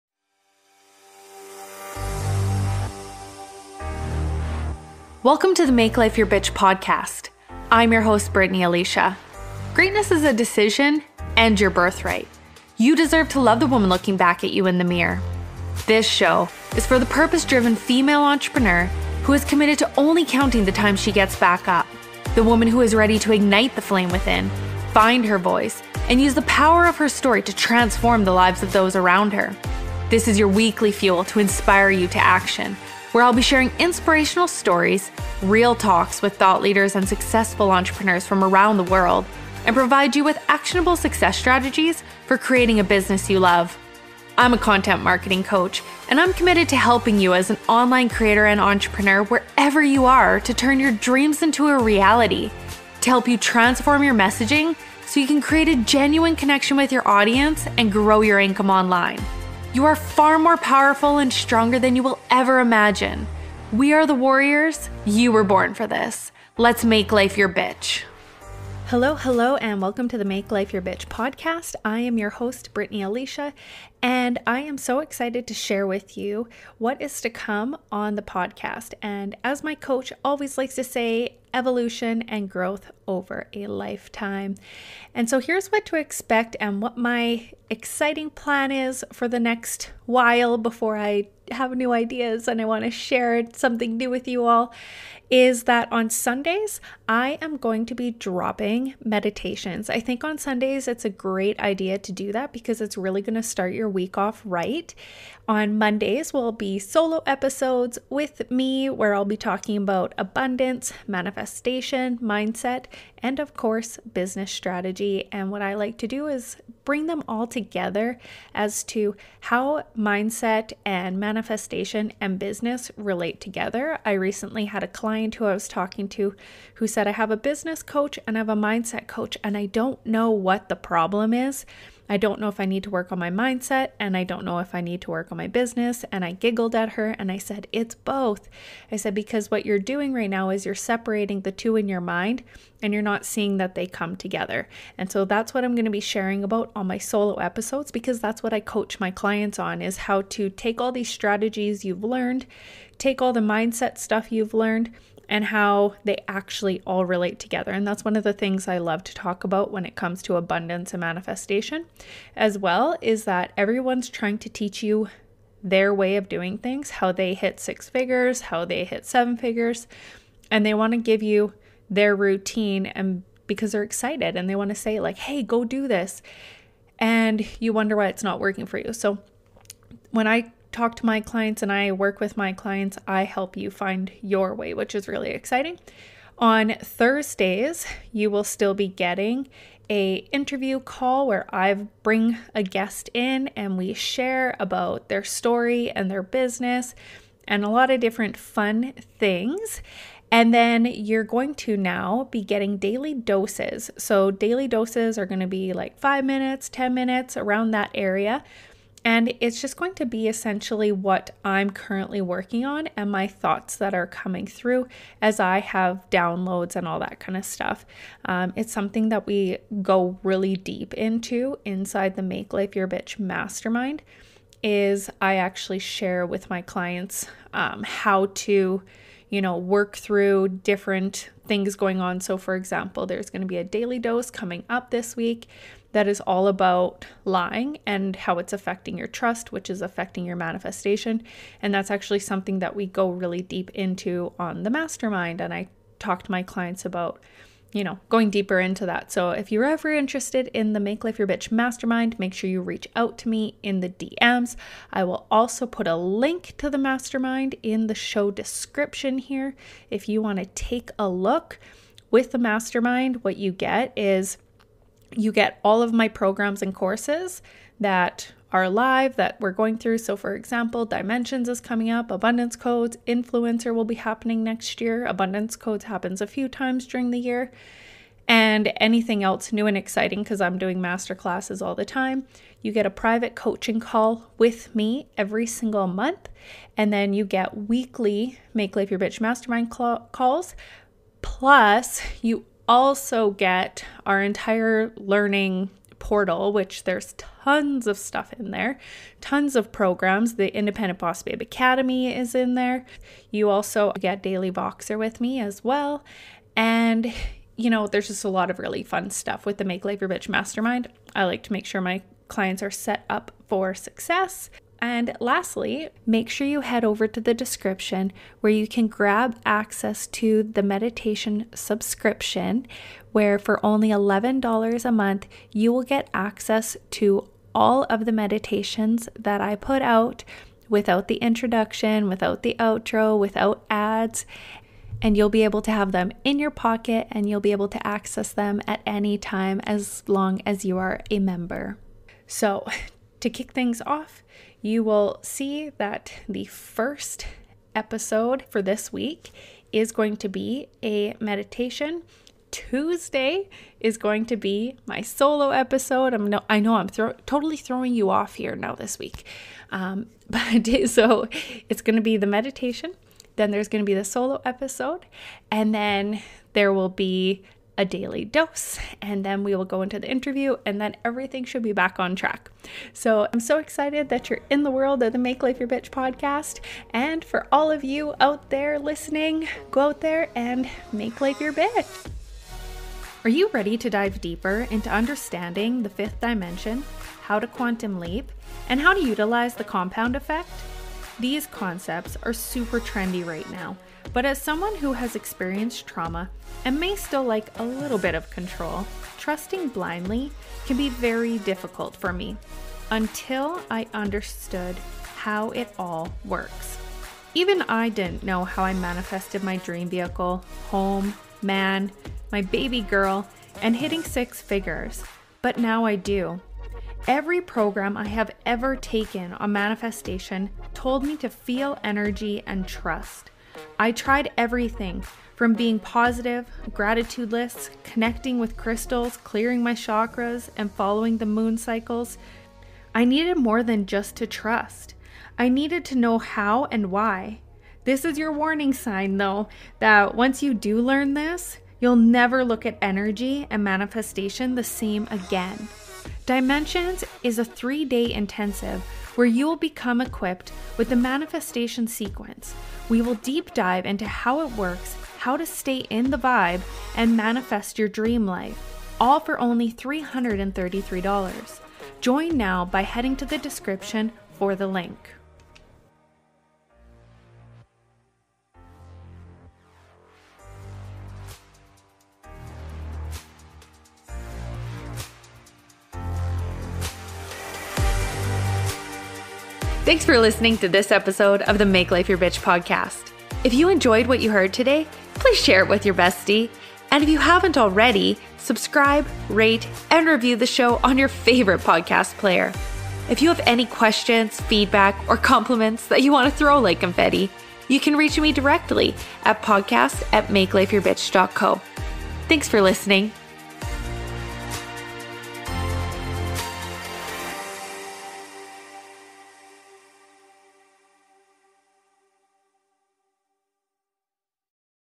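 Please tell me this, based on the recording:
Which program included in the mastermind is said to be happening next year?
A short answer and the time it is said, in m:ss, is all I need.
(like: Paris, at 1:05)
Influencer, at 4:33.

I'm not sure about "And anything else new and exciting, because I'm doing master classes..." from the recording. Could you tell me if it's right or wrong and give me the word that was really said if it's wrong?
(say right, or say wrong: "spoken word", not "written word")
right.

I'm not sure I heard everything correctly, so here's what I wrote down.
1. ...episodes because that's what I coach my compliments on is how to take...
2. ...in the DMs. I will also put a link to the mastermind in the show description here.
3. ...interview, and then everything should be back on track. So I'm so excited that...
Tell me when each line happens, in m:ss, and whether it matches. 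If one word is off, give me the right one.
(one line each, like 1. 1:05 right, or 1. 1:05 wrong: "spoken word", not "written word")
1. 2:27 wrong: "clients", not "compliments"
2. 4:13 right
3. 6:10 right.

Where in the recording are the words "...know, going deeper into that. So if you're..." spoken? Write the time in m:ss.
4:07.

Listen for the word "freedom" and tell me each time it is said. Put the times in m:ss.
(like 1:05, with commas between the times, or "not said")
not said.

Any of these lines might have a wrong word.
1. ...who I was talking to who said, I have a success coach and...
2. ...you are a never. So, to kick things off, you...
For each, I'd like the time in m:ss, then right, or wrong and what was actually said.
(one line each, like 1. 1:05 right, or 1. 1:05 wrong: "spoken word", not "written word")
1. 2:05 wrong: "business", not "success"
2. 5:40 wrong: "member", not "never".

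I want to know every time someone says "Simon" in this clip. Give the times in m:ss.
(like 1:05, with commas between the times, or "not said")
not said.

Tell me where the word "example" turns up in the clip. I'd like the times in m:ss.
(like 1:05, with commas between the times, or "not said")
3:52, 4:30.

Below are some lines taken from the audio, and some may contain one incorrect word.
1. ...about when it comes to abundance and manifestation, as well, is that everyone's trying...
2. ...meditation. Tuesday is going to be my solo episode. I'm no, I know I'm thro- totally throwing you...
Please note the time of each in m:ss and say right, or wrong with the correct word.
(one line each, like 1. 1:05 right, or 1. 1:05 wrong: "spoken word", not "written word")
1. 2:39 right
2. 5:51 right.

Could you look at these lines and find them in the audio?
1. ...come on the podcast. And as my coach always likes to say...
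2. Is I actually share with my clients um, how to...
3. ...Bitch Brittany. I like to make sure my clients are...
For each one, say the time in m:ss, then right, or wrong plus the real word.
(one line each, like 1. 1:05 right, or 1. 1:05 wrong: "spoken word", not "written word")
1. 1:17 right
2. 3:44 right
3. 5:10 wrong: "Mastermind", not "Brittany".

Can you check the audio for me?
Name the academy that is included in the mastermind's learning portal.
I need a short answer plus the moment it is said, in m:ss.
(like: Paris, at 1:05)
Independent Boss Babe Academy, at 5:00.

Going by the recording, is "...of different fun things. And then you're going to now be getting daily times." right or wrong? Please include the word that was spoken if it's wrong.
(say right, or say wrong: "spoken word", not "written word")
wrong: "doses", not "times".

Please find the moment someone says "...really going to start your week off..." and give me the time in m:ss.
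1:42.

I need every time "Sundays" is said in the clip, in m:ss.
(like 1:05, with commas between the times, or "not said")
1:36, 1:40.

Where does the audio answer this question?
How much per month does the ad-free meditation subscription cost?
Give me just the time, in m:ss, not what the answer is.
5:23.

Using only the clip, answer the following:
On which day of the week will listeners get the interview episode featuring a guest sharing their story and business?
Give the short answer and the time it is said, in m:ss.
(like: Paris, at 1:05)
Thursdays, at 3:06.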